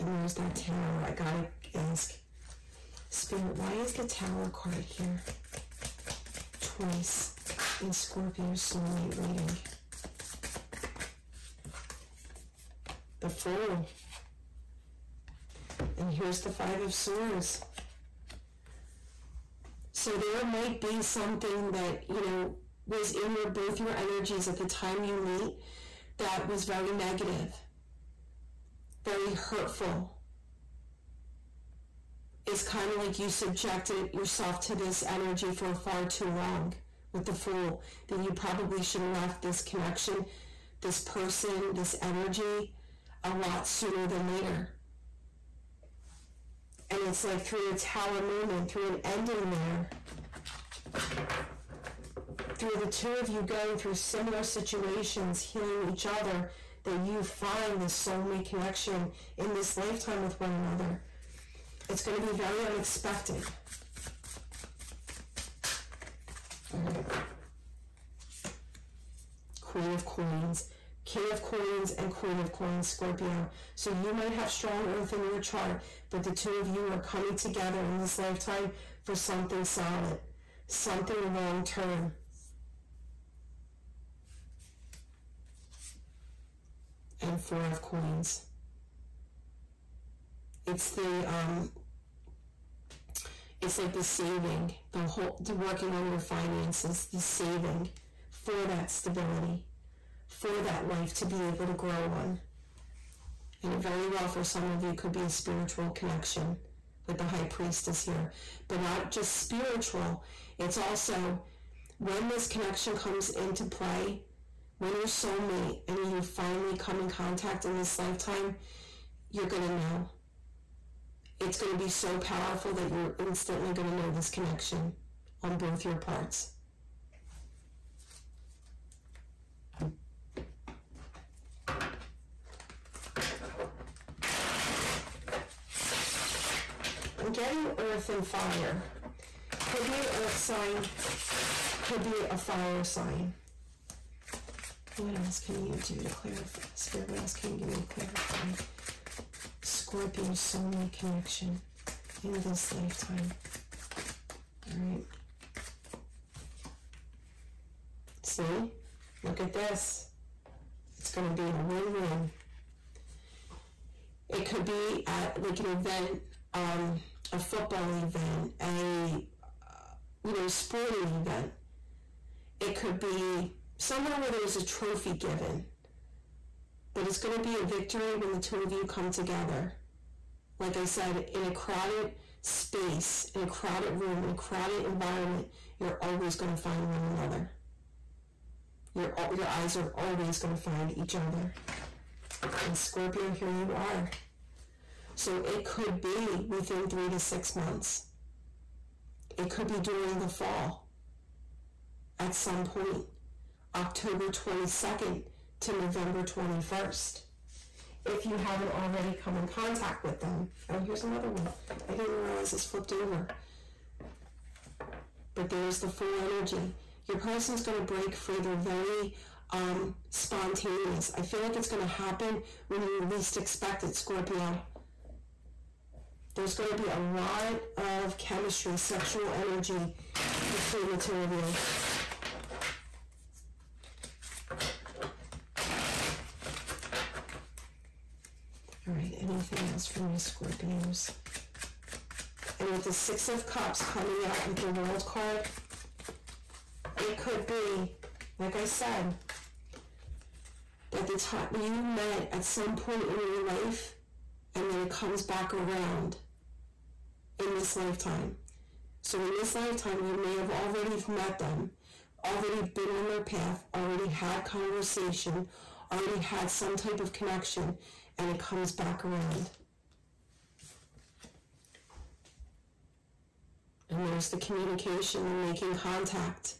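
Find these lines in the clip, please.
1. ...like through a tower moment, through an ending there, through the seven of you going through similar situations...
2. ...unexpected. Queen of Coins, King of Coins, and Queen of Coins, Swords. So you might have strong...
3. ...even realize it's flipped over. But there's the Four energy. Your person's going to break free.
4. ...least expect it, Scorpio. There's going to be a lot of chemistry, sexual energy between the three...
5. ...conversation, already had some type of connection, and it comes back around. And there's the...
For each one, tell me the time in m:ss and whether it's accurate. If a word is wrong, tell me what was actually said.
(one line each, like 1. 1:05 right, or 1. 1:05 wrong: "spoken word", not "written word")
1. 0:47 wrong: "two", not "seven"
2. 1:02 wrong: "Scorpio", not "Swords"
3. 3:32 wrong: "Fool", not "Four"
4. 3:43 wrong: "two", not "three"
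5. 4:24 right.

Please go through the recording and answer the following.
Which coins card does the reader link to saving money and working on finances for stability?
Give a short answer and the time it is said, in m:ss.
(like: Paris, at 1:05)
Four of Coins, at 1:27.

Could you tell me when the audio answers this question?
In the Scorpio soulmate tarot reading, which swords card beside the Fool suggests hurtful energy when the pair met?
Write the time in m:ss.
0:16.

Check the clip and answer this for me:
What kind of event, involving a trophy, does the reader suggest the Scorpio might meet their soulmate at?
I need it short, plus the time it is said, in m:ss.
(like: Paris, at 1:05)
football event, at 2:47.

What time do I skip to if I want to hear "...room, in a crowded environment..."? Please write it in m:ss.
3:03.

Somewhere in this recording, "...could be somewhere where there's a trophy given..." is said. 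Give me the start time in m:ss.
2:52.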